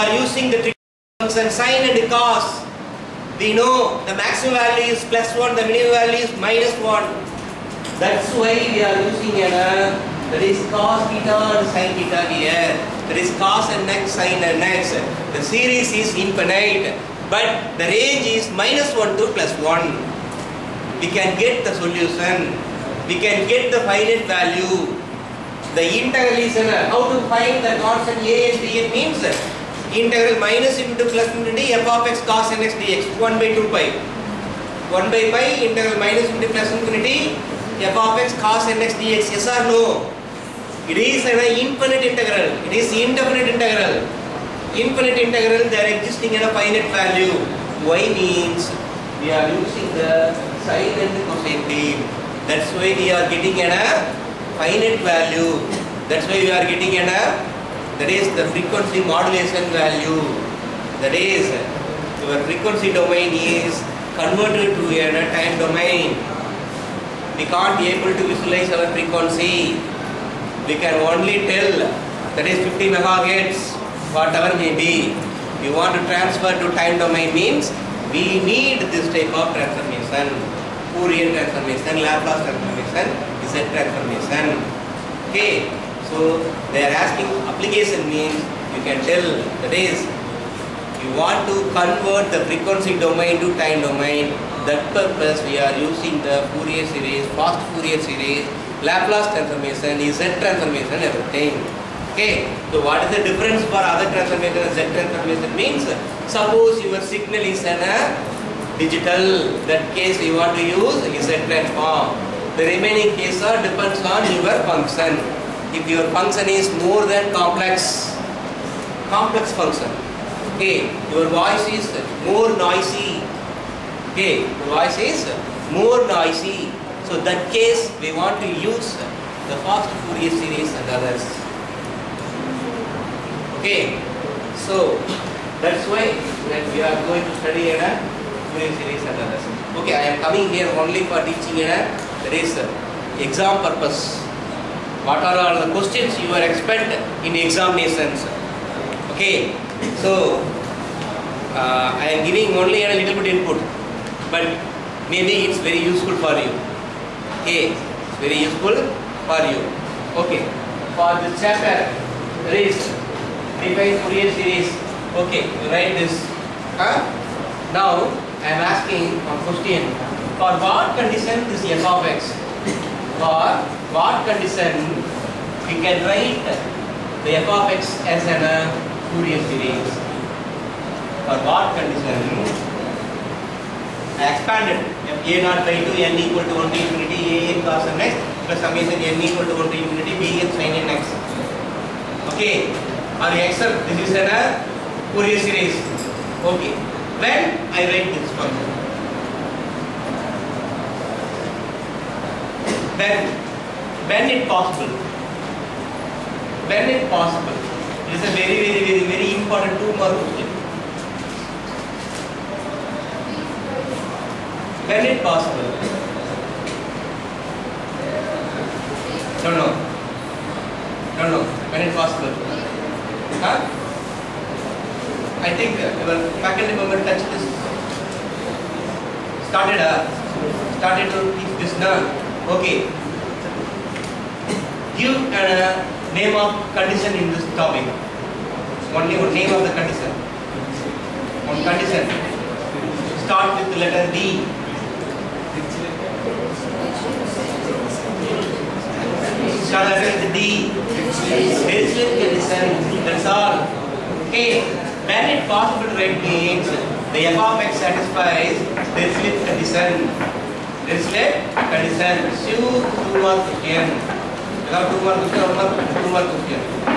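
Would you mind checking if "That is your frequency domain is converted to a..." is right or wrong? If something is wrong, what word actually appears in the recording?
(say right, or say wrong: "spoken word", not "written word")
right.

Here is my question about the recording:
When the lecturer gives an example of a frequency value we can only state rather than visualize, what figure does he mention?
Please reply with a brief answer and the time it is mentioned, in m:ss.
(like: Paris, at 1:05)
50 megahertz, at 1:12.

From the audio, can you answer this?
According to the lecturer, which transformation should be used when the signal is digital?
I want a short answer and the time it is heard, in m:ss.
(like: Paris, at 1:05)
Z transform, at 1:51.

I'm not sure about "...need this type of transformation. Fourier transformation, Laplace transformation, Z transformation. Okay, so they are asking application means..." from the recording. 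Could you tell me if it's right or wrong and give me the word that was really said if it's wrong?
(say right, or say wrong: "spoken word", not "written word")
right.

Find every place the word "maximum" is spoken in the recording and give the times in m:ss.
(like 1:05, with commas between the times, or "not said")
0:04.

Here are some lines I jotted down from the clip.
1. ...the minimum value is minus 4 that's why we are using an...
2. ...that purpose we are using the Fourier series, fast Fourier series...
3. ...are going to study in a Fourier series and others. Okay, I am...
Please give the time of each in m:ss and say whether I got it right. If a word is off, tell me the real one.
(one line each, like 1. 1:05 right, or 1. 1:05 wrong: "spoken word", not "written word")
1. 0:05 wrong: "1", not "4"
2. 1:34 right
3. 2:16 right.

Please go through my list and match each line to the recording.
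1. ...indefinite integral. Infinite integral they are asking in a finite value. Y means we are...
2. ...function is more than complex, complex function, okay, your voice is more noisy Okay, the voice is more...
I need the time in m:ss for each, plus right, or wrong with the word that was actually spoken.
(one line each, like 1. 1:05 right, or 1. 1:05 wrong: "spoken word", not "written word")
1. 0:42 wrong: "existing", not "asking"
2. 1:56 right.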